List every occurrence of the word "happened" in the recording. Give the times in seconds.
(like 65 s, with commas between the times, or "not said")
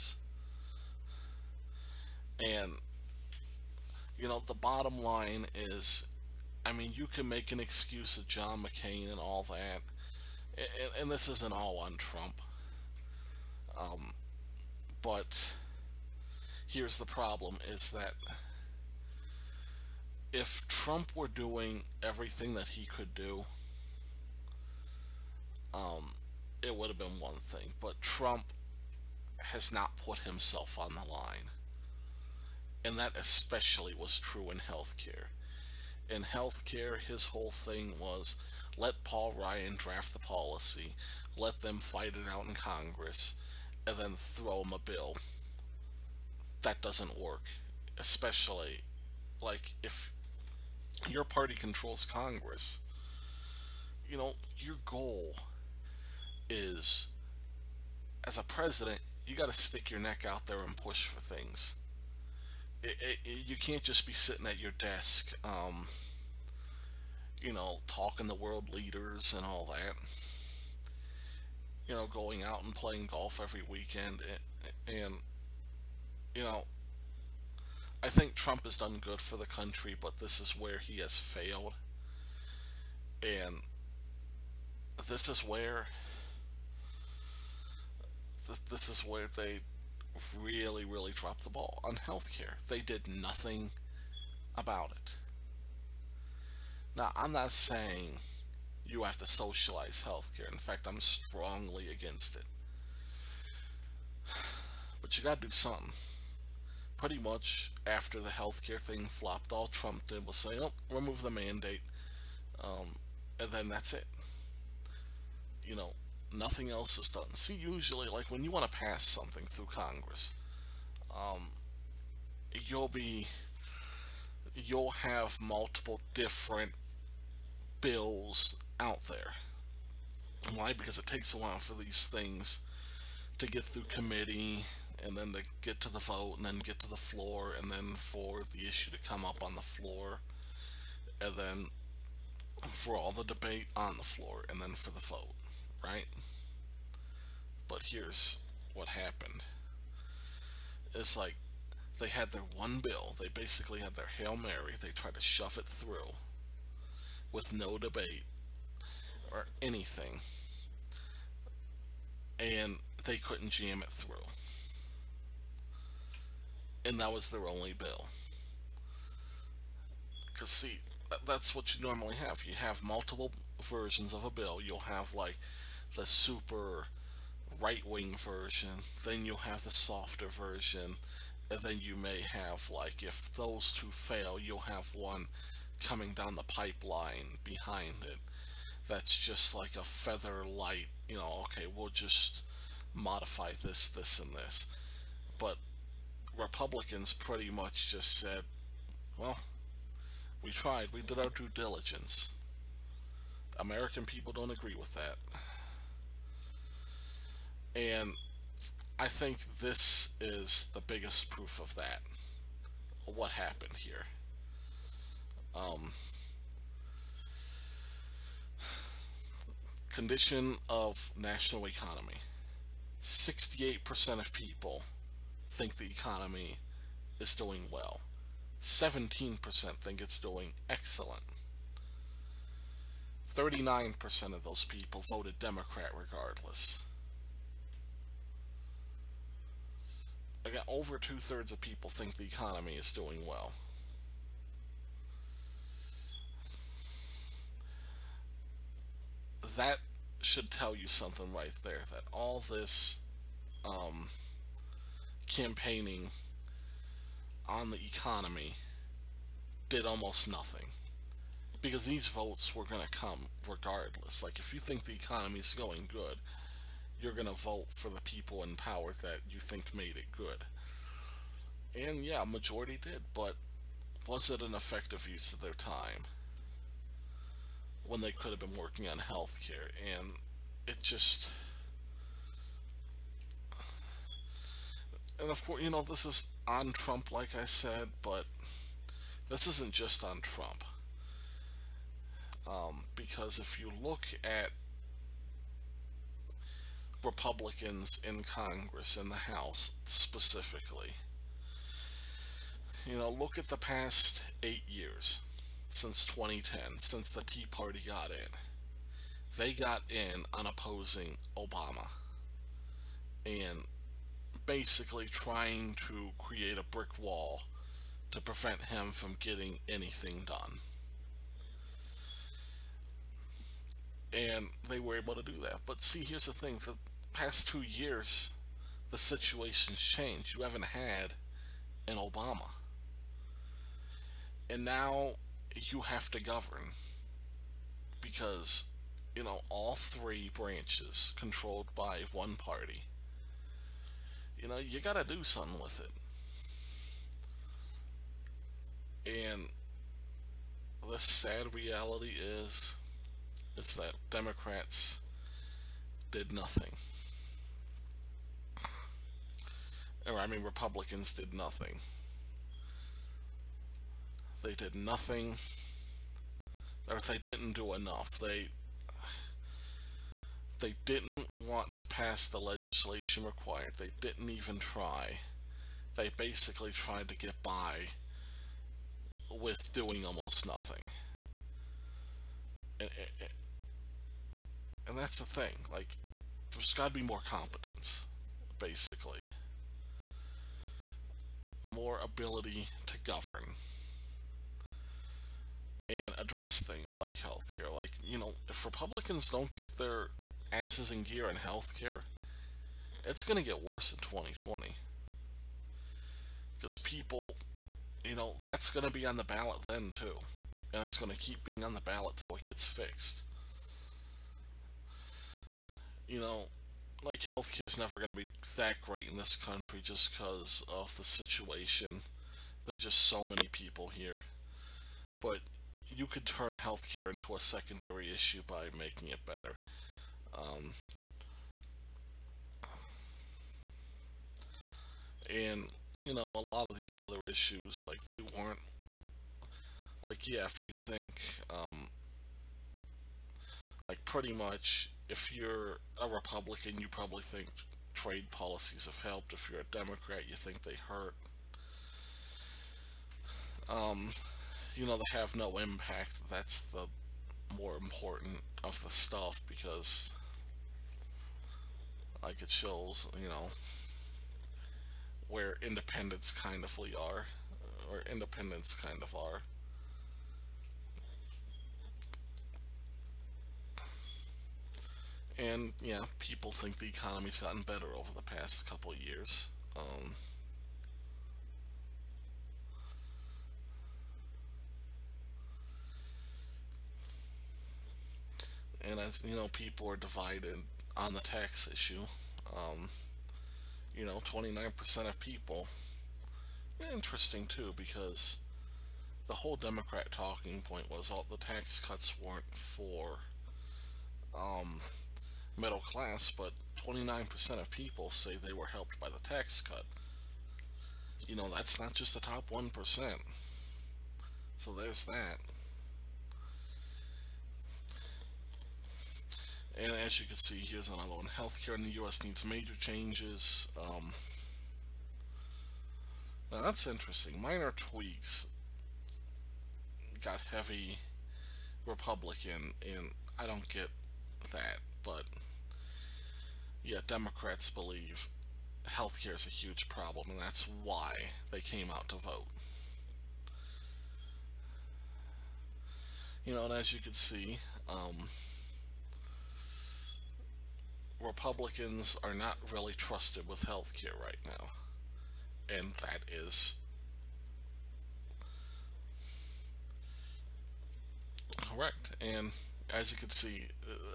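148 s, 213 s.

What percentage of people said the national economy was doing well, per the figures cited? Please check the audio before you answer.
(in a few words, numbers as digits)
68%.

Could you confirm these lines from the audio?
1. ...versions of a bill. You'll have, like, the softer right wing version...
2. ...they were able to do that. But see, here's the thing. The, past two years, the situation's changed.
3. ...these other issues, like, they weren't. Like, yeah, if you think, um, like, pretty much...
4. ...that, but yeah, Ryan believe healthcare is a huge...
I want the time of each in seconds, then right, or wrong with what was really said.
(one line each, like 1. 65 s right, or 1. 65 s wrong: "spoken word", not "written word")
1. 173 s wrong: "super", not "softer"
2. 324 s right
3. 436 s right
4. 534 s wrong: "Democrats", not "Ryan".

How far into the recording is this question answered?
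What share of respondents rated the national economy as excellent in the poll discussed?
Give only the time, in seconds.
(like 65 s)
228 s.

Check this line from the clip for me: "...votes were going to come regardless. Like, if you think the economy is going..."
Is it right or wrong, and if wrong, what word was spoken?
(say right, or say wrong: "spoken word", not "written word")
right.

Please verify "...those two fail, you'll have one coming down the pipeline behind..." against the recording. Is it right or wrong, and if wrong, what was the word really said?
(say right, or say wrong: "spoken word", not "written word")
right.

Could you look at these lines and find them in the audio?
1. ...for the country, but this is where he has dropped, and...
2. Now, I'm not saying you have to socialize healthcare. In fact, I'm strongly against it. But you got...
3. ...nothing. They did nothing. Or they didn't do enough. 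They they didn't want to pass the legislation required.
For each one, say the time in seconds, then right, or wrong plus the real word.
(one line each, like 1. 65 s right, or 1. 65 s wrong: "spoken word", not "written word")
1. 79 s wrong: "failed", not "dropped"
2. 96 s right
3. 361 s right.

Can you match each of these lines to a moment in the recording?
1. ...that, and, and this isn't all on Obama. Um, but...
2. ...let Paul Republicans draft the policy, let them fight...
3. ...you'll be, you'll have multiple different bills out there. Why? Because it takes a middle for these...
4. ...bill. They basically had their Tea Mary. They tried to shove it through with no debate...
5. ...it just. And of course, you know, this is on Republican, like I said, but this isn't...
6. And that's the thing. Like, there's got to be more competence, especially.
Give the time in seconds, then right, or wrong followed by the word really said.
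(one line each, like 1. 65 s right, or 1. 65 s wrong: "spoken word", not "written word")
1. 9 s wrong: "Trump", not "Obama"
2. 38 s wrong: "Ryan", not "Republicans"
3. 122 s wrong: "while", not "middle"
4. 152 s wrong: "Hail", not "Tea"
5. 280 s wrong: "Trump", not "Republican"
6. 384 s wrong: "basically", not "especially".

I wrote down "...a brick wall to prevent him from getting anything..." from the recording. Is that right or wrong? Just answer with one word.
right.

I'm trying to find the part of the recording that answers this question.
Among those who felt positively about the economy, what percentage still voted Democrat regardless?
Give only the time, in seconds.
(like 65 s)
233 s.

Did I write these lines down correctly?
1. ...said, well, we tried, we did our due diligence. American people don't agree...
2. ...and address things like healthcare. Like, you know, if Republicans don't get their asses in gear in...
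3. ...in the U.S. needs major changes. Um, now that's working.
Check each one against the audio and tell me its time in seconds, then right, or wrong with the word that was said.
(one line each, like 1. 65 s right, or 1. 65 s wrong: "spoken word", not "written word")
1. 198 s right
2. 395 s right
3. 521 s wrong: "interesting", not "working".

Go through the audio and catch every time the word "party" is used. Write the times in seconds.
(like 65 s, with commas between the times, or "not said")
51 s, 307 s, 342 s.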